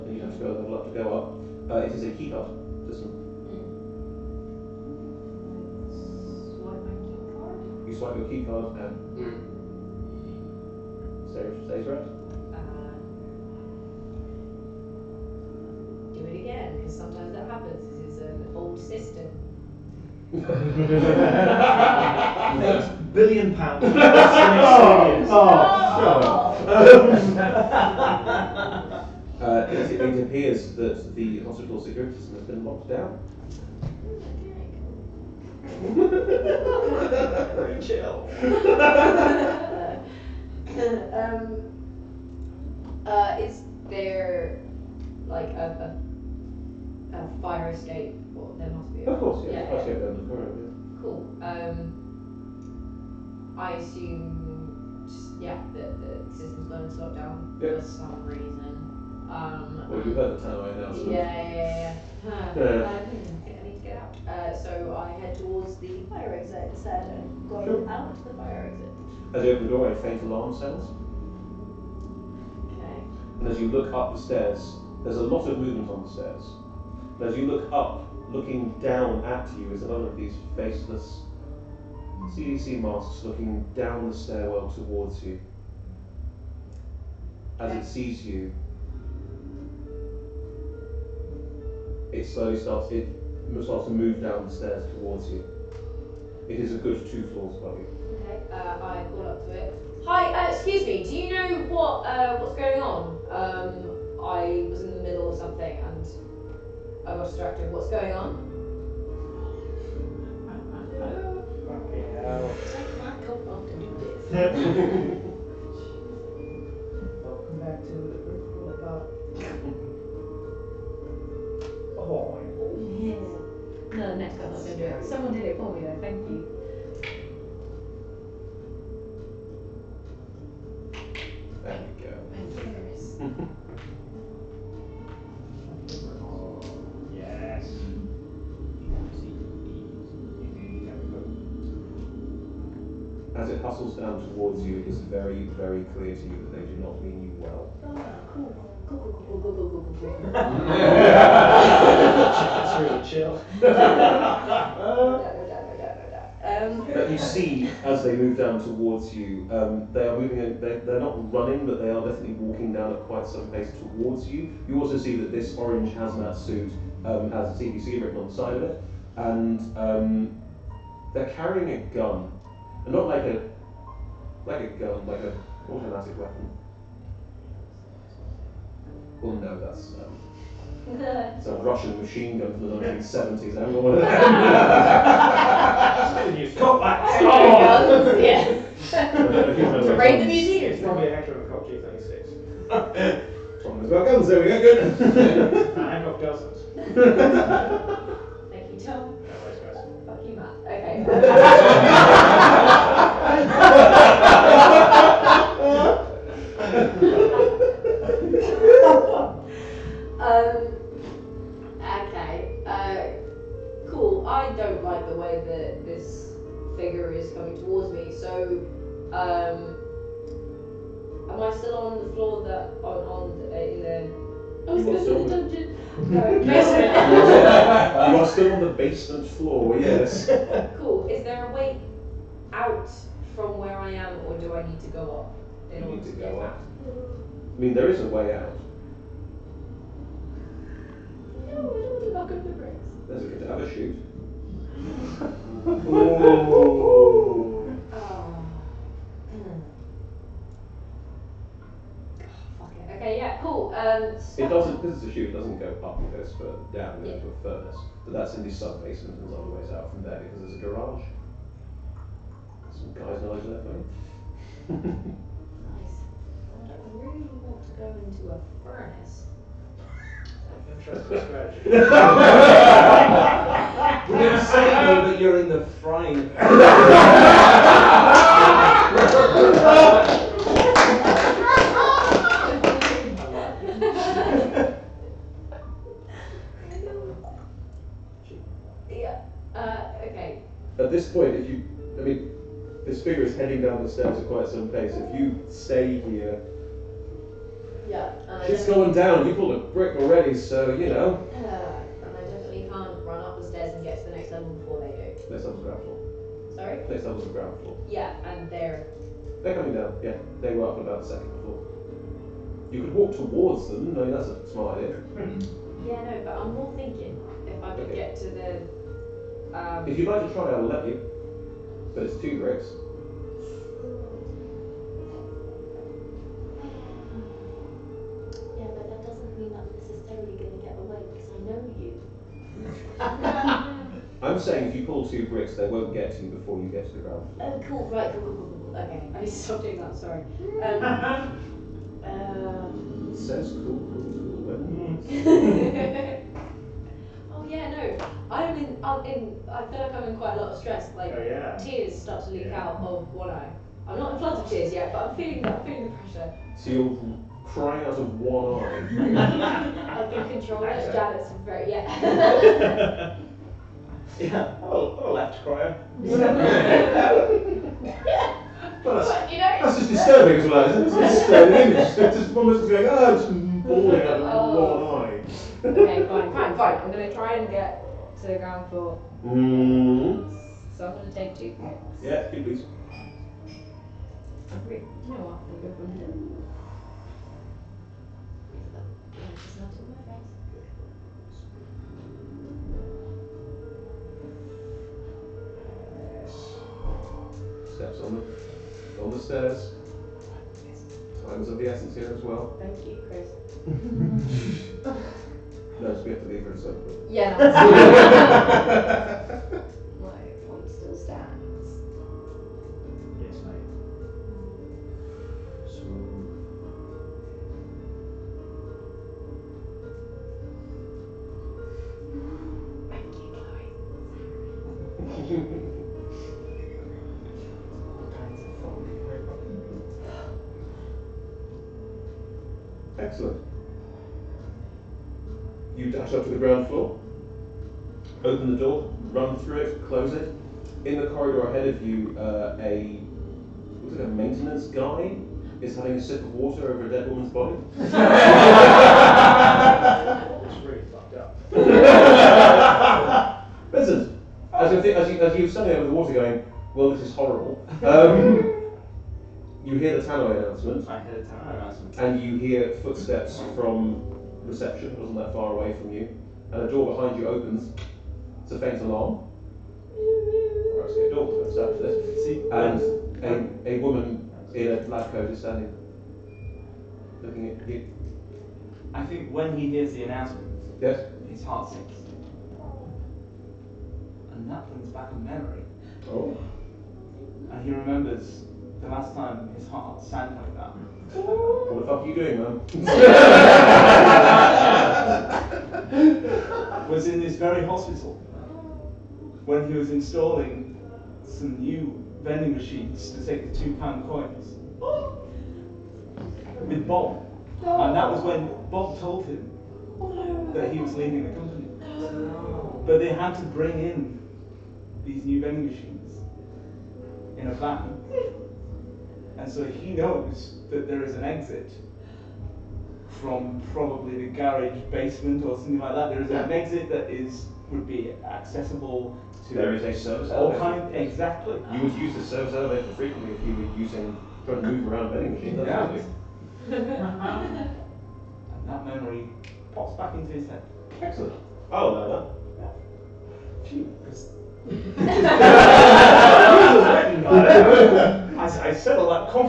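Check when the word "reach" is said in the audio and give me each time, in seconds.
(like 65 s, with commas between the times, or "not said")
not said.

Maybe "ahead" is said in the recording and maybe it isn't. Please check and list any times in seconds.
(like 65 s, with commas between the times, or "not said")
441 s.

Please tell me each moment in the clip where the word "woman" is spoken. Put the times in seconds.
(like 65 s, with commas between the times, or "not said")
447 s, 473 s.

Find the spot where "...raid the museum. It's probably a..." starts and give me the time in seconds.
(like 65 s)
189 s.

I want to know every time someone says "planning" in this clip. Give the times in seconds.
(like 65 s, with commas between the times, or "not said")
not said.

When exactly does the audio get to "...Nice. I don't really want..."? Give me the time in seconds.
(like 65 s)
264 s.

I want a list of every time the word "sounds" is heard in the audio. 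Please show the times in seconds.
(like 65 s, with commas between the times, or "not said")
70 s.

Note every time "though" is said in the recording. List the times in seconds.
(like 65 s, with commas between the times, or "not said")
125 s, 274 s.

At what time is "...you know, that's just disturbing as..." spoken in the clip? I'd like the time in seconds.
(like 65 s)
369 s.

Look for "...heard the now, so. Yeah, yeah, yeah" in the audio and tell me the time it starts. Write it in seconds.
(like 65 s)
60 s.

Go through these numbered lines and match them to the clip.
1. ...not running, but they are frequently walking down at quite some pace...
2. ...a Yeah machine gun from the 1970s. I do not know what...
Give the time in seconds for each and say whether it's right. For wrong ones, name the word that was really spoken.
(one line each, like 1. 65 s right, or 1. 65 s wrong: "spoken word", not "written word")
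1. 161 s wrong: "definitely", not "frequently"
2. 181 s wrong: "Russian", not "Yeah".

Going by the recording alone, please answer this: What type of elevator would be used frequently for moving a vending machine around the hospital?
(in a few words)
service elevator.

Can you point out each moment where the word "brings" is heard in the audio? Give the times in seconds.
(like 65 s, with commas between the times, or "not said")
484 s, 513 s.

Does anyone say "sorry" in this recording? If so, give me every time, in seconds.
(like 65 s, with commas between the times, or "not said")
306 s, 339 s.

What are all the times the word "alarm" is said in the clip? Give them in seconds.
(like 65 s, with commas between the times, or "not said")
70 s, 468 s.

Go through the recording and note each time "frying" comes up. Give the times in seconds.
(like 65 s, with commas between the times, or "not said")
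275 s.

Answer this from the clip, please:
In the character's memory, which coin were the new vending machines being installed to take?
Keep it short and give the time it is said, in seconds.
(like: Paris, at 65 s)
2 pound coins, at 503 s.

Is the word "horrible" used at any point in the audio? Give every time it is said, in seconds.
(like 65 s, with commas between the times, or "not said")
457 s.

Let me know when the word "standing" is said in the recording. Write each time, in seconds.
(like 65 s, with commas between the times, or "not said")
455 s, 475 s.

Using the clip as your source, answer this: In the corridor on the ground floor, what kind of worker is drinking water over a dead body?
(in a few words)
maintenance guy.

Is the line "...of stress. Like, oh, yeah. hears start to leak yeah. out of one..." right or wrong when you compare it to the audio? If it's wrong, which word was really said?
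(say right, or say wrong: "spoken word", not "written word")
wrong: "tears", not "hears".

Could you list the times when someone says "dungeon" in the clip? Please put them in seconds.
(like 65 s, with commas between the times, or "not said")
225 s.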